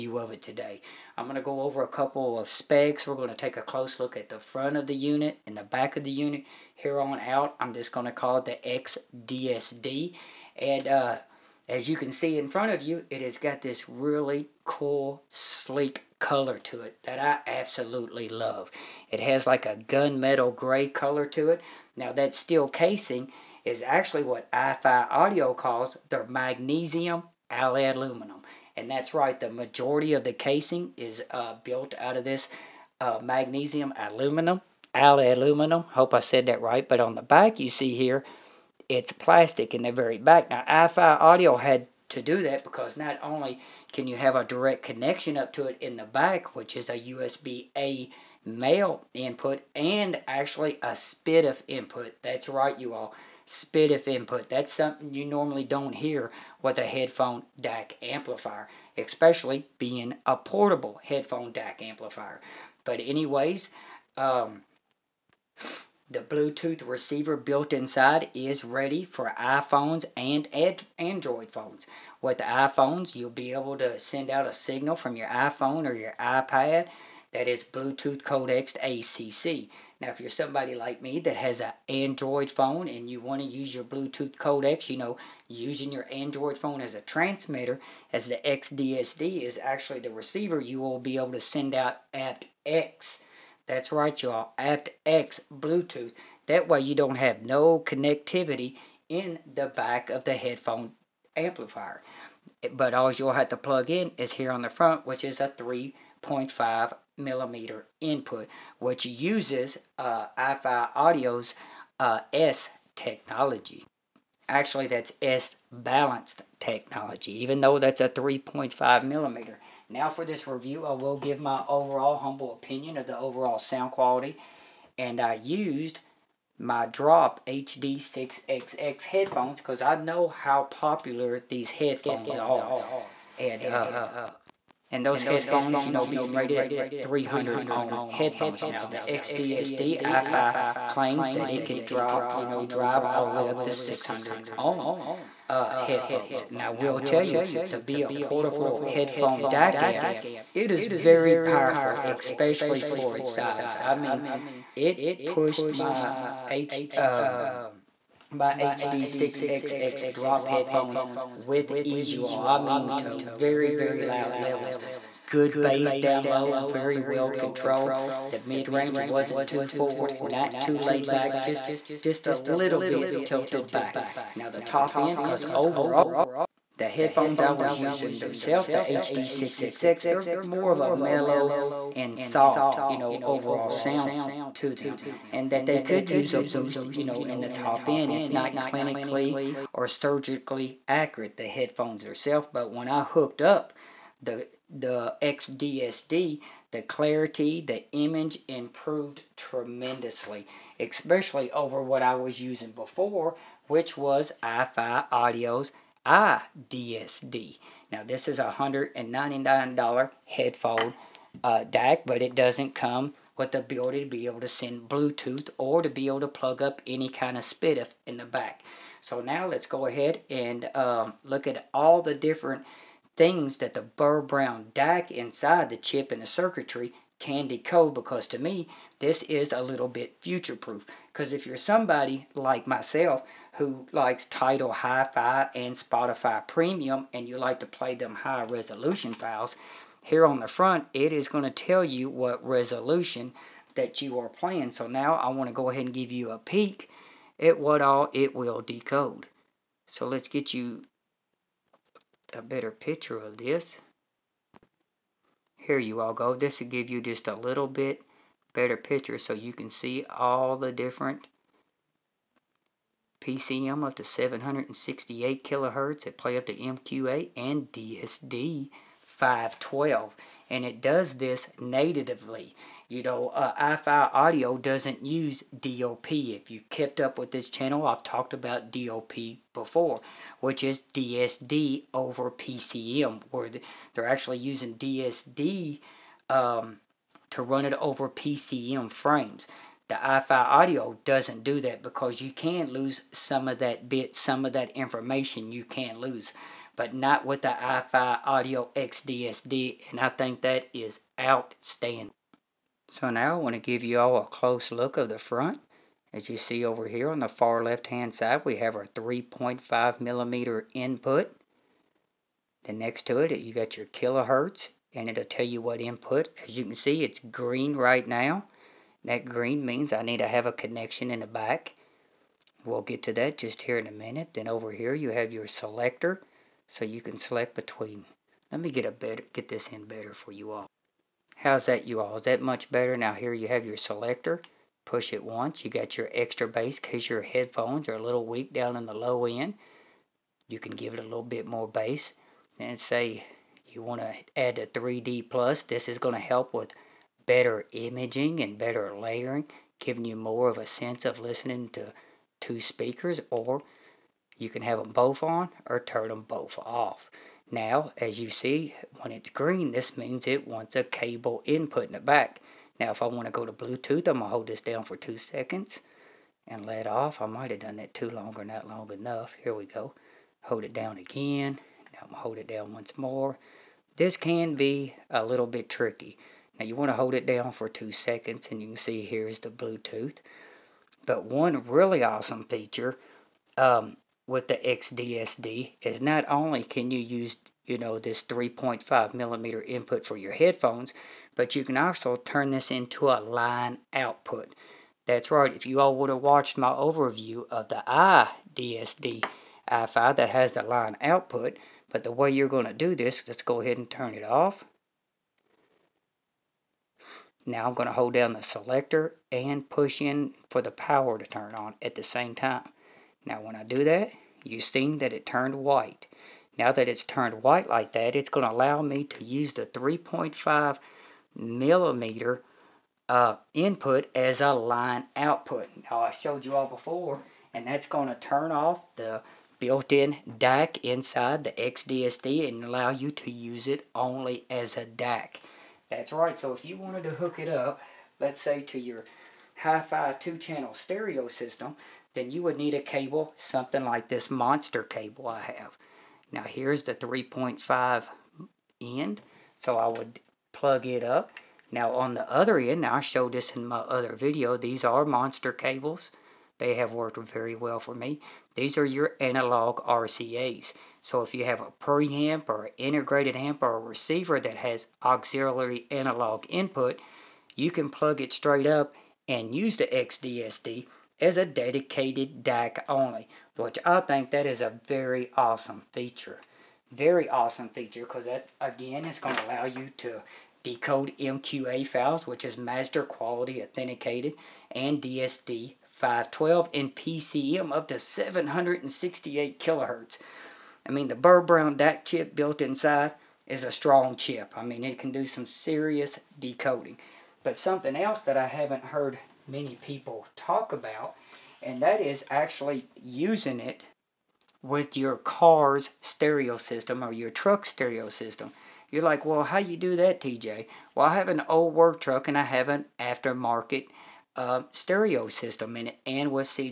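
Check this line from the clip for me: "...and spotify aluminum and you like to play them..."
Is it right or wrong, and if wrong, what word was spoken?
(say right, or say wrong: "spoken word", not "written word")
wrong: "premium", not "aluminum".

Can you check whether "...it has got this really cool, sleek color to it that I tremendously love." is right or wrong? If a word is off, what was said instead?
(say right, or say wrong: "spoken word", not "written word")
wrong: "absolutely", not "tremendously".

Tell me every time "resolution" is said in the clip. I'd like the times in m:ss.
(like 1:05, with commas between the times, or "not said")
3:58, 4:02.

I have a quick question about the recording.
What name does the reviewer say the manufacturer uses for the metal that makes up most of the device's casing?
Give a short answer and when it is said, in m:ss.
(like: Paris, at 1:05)
magnesium alloy aluminum, at 0:26.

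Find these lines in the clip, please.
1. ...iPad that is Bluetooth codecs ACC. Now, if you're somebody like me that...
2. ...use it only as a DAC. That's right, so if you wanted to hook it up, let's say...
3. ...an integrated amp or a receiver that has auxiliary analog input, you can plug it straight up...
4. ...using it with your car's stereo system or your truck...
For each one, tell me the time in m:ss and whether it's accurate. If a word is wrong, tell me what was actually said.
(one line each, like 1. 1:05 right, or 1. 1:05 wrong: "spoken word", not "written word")
1. 1:16 right
2. 7:13 right
3. 7:42 right
4. 8:23 right.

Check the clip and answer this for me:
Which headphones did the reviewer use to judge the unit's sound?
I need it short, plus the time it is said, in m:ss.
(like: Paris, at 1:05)
Drop HD6XX, at 2:06.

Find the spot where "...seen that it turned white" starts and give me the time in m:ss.
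6:54.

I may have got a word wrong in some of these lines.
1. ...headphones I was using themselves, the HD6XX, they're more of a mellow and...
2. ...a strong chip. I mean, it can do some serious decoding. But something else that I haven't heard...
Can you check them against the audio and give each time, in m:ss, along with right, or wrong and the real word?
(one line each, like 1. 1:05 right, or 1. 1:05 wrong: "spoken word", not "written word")
1. 2:56 right
2. 8:13 right.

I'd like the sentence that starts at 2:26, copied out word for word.
Now, we will tell you, to be a portable headphone DAC amp, it is very powerful, especially for its size.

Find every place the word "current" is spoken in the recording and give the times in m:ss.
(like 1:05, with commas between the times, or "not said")
not said.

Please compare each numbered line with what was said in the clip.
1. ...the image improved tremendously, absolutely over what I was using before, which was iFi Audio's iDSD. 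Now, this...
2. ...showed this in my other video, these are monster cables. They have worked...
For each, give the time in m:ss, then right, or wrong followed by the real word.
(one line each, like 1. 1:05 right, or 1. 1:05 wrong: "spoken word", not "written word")
1. 3:17 wrong: "especially", not "absolutely"
2. 7:33 right.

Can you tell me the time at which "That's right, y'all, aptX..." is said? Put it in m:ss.
1:33.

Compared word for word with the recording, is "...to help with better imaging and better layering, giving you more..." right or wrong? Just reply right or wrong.
right.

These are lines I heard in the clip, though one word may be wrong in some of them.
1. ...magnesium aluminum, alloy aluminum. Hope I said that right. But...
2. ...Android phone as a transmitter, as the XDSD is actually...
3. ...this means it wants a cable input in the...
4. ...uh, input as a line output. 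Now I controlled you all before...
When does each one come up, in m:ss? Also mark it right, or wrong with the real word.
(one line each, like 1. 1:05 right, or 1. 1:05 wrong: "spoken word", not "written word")
1. 0:33 right
2. 1:26 right
3. 5:59 right
4. 7:03 wrong: "showed", not "controlled".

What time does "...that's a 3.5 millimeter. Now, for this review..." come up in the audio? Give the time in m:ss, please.
1:57.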